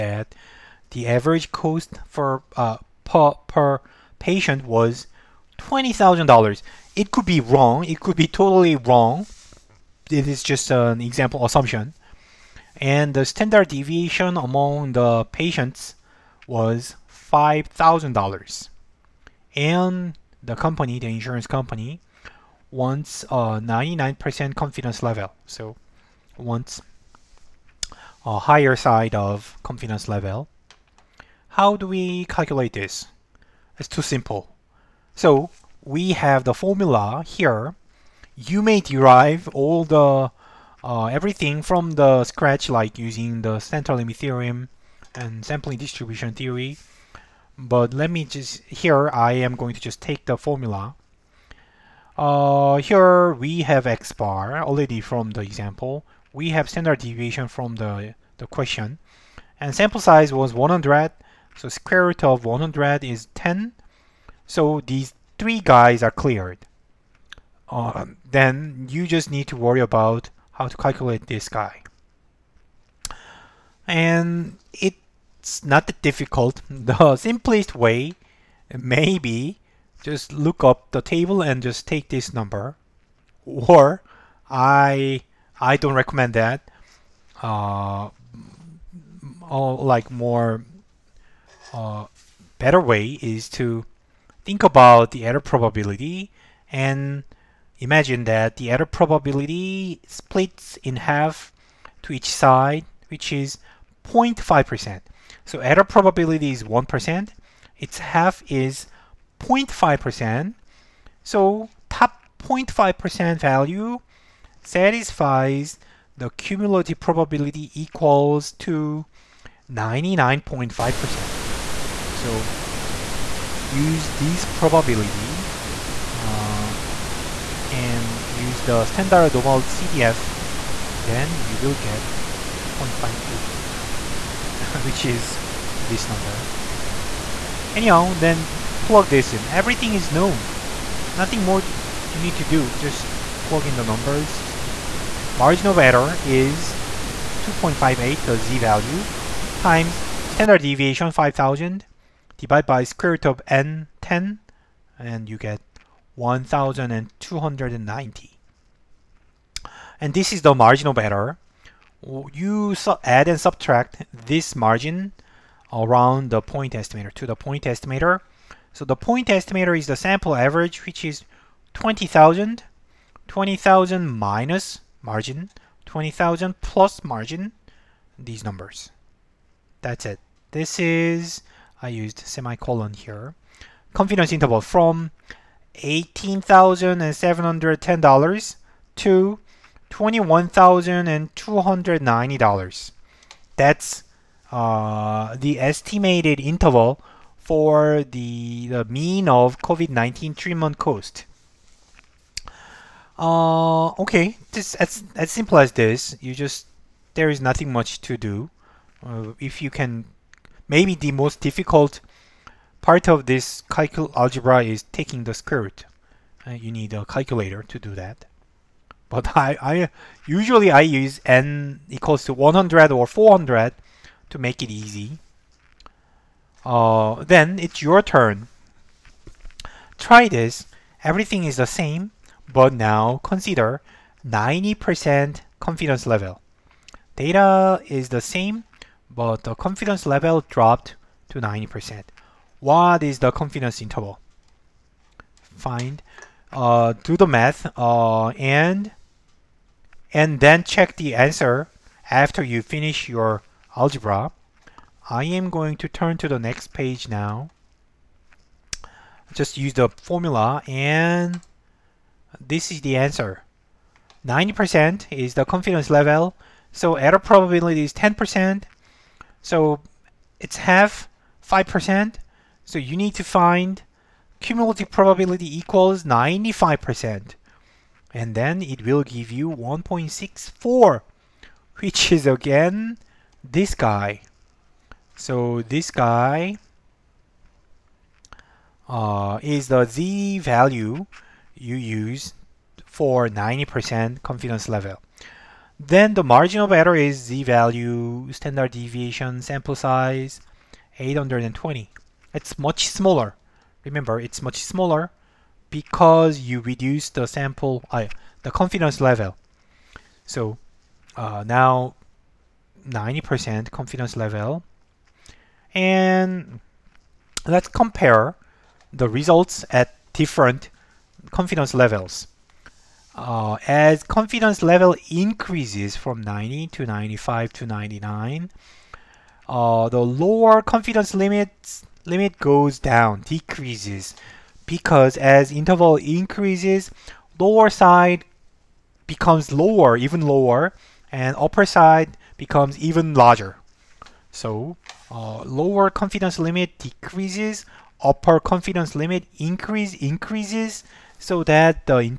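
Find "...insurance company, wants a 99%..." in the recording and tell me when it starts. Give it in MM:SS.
00:21.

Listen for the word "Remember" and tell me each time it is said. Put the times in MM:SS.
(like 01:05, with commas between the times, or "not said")
05:03.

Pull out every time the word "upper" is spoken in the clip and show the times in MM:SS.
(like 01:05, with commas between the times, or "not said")
05:41, 05:48.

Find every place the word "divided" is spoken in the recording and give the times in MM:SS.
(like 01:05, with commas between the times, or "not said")
02:32.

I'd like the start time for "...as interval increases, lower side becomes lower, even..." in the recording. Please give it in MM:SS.
05:35.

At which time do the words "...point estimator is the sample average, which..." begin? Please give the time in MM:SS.
02:48.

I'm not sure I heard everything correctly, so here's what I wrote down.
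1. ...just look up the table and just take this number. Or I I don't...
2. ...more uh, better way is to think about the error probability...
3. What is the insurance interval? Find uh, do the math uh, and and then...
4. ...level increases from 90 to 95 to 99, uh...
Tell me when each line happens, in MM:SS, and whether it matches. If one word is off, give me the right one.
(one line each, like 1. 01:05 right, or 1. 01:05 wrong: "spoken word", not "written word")
1. 01:20 right
2. 01:30 right
3. 04:02 wrong: "confidence", not "insurance"
4. 05:24 right.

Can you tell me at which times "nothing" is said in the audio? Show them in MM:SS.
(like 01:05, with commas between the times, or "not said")
02:21, 03:27.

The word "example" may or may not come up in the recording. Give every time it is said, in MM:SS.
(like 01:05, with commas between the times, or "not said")
00:11, 00:55.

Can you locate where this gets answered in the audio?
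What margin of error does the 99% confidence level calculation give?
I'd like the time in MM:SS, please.
02:36.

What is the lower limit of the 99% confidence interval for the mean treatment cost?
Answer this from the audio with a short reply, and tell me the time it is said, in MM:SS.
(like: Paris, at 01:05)
$18,710, at 03:05.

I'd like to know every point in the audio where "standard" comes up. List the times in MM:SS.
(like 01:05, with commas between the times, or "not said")
00:13, 00:56, 02:08, 02:30, 04:58.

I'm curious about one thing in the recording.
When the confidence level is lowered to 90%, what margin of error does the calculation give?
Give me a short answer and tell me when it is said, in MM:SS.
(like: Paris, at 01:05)
820, at 05:00.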